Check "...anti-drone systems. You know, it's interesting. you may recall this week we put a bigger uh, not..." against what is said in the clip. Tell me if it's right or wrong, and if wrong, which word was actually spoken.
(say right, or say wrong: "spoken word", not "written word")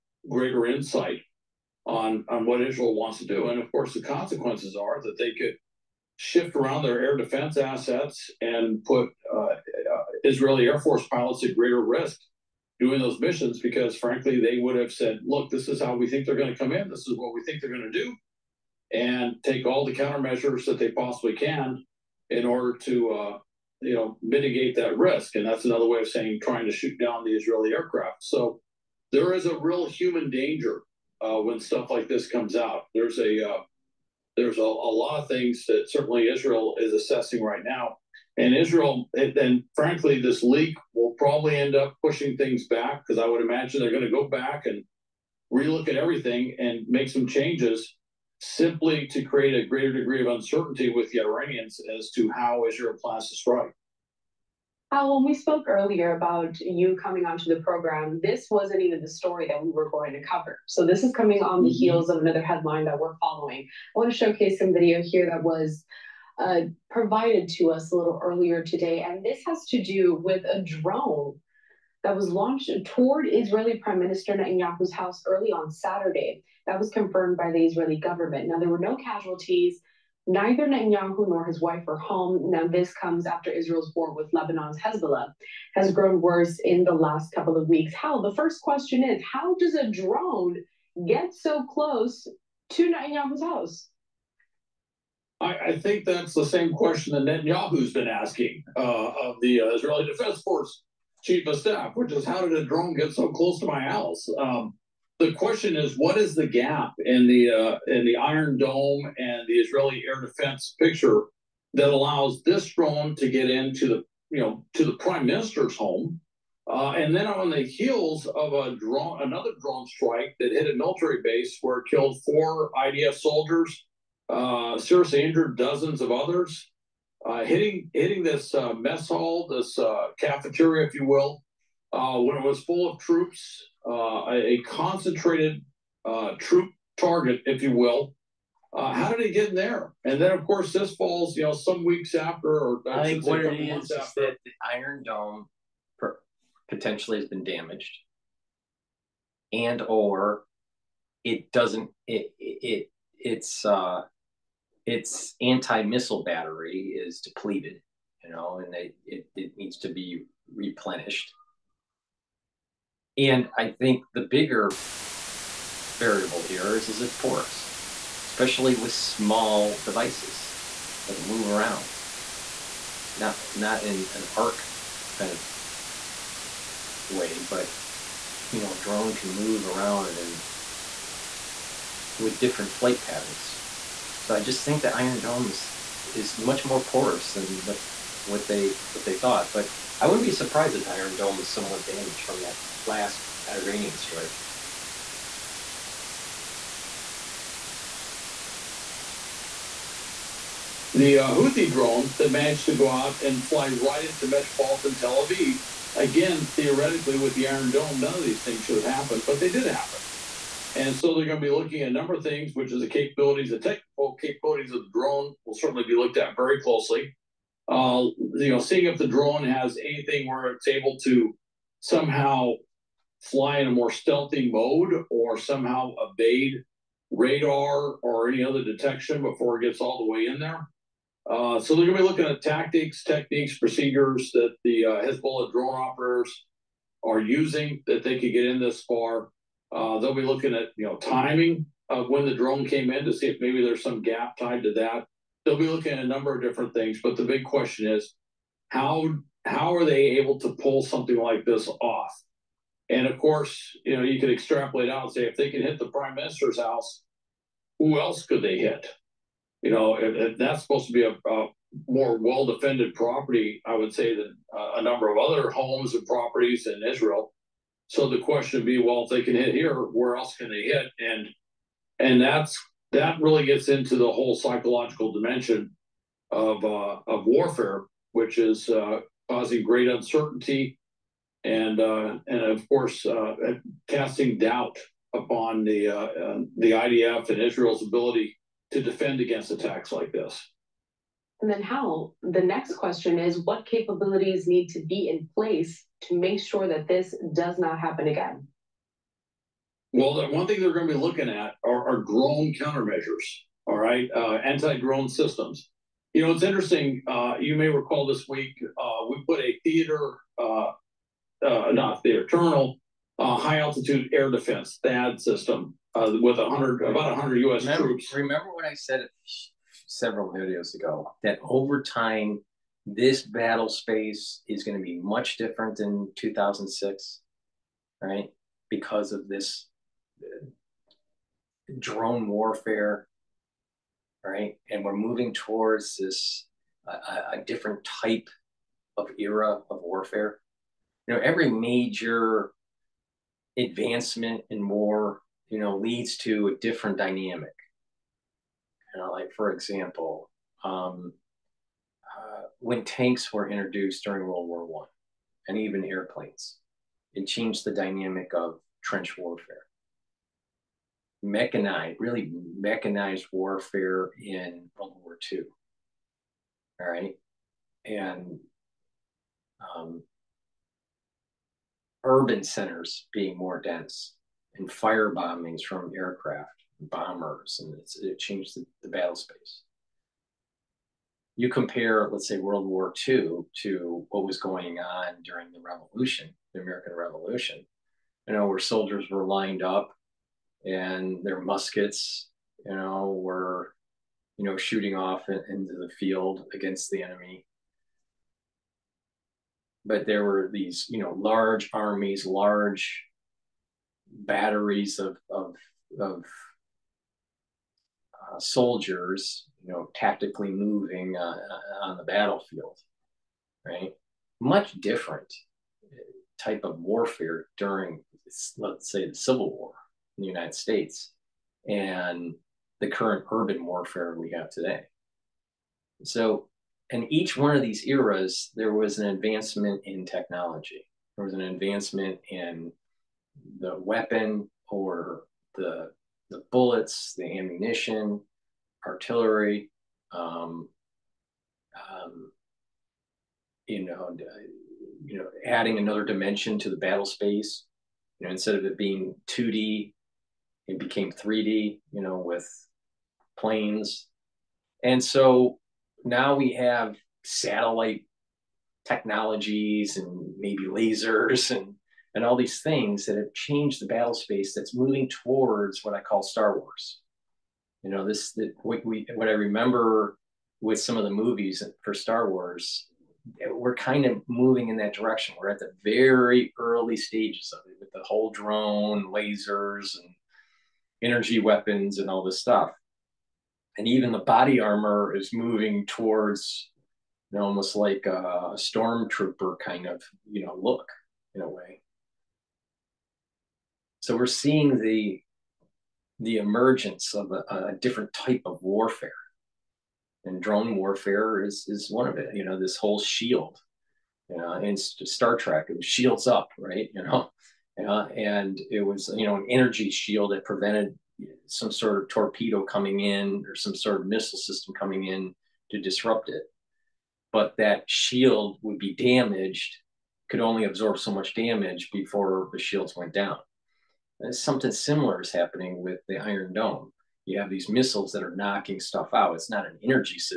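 wrong: "theater", not "bigger".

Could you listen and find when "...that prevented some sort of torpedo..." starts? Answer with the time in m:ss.
8:30.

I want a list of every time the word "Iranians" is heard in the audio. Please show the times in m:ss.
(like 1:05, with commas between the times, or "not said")
0:51, 3:13.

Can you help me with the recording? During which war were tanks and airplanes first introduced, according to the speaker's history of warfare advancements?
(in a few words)
World War One.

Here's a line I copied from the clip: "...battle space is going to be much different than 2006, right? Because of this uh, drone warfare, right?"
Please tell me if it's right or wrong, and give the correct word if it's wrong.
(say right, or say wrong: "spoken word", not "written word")
right.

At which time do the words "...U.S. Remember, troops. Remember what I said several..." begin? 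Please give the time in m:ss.
5:17.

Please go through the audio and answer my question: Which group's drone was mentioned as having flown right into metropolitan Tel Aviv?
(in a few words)
Houthi.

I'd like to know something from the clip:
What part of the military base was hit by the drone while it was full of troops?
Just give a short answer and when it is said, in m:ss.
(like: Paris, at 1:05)
mess hall, at 2:08.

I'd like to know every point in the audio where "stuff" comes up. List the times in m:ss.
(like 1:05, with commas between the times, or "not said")
0:31, 8:02, 8:48.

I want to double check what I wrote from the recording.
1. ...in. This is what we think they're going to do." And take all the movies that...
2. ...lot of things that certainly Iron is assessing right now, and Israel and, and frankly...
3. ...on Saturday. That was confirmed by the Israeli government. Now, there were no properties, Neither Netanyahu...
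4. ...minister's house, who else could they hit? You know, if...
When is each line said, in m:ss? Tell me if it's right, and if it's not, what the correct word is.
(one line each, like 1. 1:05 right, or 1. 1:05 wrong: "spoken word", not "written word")
1. 0:16 wrong: "countermeasures", not "movies"
2. 0:34 wrong: "Israel", not "Iron"
3. 1:15 wrong: "casualties", not "properties"
4. 4:16 right.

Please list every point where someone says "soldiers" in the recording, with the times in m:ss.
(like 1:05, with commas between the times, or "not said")
2:03, 6:28, 6:48.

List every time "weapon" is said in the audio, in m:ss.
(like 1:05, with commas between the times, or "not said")
7:13, 8:01.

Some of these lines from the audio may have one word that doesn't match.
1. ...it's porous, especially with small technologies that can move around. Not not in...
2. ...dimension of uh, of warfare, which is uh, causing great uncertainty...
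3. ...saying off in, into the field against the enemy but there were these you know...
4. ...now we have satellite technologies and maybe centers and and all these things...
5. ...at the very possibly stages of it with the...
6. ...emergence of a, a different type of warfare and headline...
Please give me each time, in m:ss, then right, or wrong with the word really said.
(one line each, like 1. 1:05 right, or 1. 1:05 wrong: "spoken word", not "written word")
1. 2:47 wrong: "devices", not "technologies"
2. 4:35 right
3. 6:34 wrong: "shooting", not "saying"
4. 7:36 wrong: "lasers", not "centers"
5. 7:55 wrong: "early", not "possibly"
6. 8:16 wrong: "drone", not "headline".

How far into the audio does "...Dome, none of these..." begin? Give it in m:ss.
3:27.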